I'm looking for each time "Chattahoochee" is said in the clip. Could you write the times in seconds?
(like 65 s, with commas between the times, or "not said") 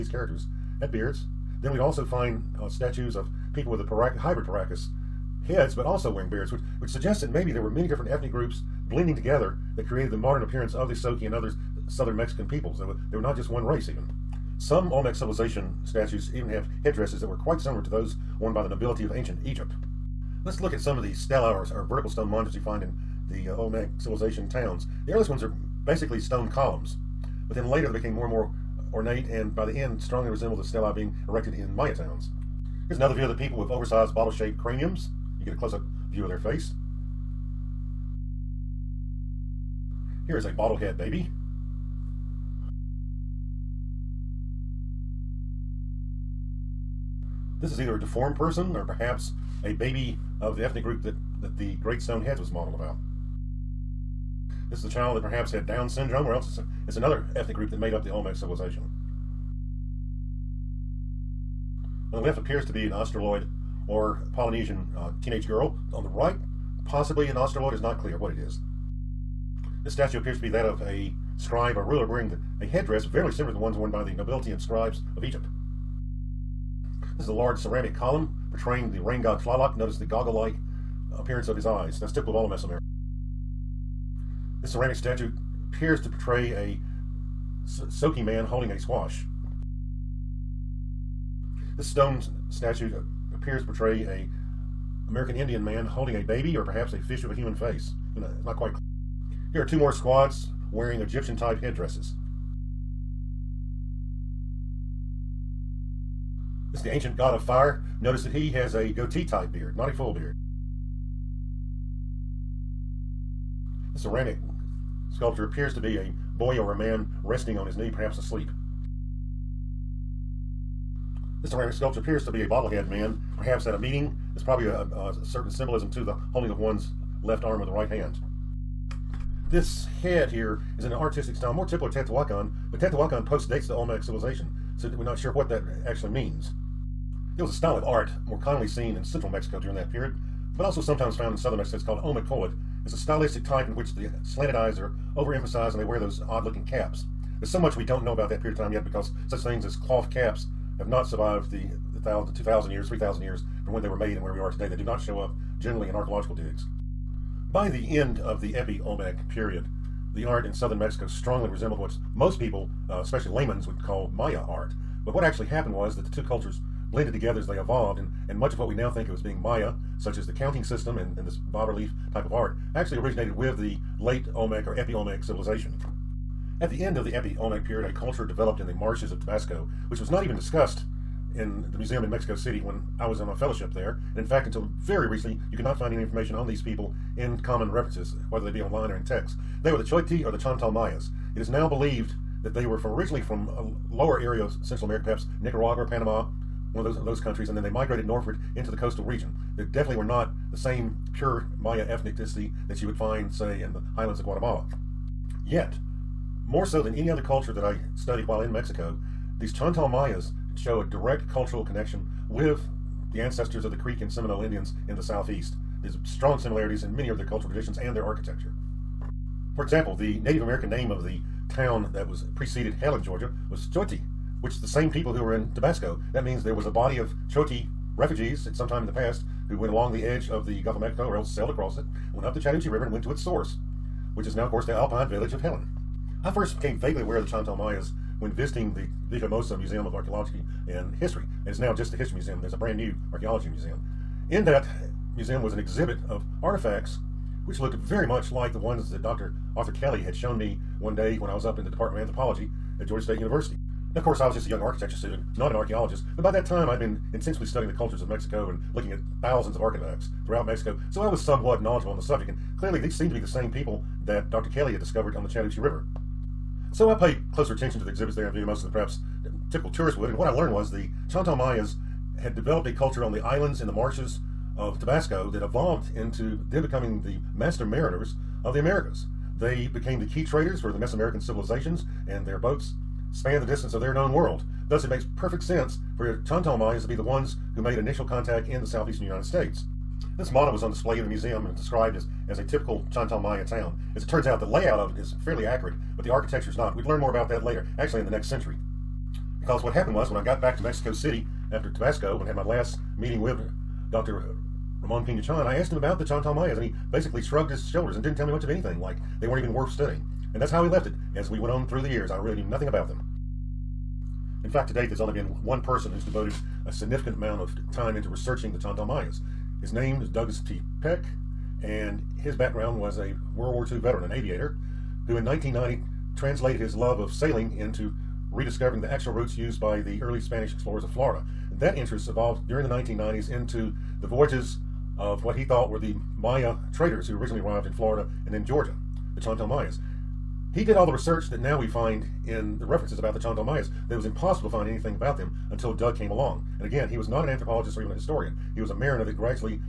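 232 s, 265 s.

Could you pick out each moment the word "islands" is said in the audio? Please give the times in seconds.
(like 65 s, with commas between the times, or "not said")
273 s.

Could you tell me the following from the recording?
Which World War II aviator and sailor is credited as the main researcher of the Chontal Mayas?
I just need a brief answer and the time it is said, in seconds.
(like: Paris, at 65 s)
Douglas T. Peck, at 320 s.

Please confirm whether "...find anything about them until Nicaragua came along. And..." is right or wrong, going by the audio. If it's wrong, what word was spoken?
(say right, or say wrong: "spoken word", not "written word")
wrong: "Doug", not "Nicaragua".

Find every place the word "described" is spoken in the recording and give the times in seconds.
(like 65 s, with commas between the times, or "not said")
291 s.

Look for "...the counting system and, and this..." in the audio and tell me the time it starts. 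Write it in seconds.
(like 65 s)
170 s.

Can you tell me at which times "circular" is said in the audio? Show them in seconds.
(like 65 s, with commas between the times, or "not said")
not said.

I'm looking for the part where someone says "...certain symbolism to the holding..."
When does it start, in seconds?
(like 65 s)
125 s.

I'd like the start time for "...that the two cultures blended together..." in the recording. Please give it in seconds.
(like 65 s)
165 s.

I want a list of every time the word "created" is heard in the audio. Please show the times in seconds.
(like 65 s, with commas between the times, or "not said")
9 s.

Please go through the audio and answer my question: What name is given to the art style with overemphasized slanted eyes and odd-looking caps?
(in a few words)
omicoid.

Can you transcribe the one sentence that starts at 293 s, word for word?
As it turns out, the layout of it is fairly accurate, but the architecture is not.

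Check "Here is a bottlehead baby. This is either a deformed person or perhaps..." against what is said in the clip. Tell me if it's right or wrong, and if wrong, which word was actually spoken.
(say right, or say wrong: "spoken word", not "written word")
right.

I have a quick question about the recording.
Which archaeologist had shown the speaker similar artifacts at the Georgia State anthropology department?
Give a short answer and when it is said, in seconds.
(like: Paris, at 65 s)
Dr. Arthur Kelly, at 249 s.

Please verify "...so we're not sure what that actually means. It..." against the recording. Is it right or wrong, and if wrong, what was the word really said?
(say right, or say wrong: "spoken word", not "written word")
right.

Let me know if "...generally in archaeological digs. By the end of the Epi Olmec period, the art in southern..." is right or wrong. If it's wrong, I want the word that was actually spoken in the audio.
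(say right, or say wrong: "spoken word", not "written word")
right.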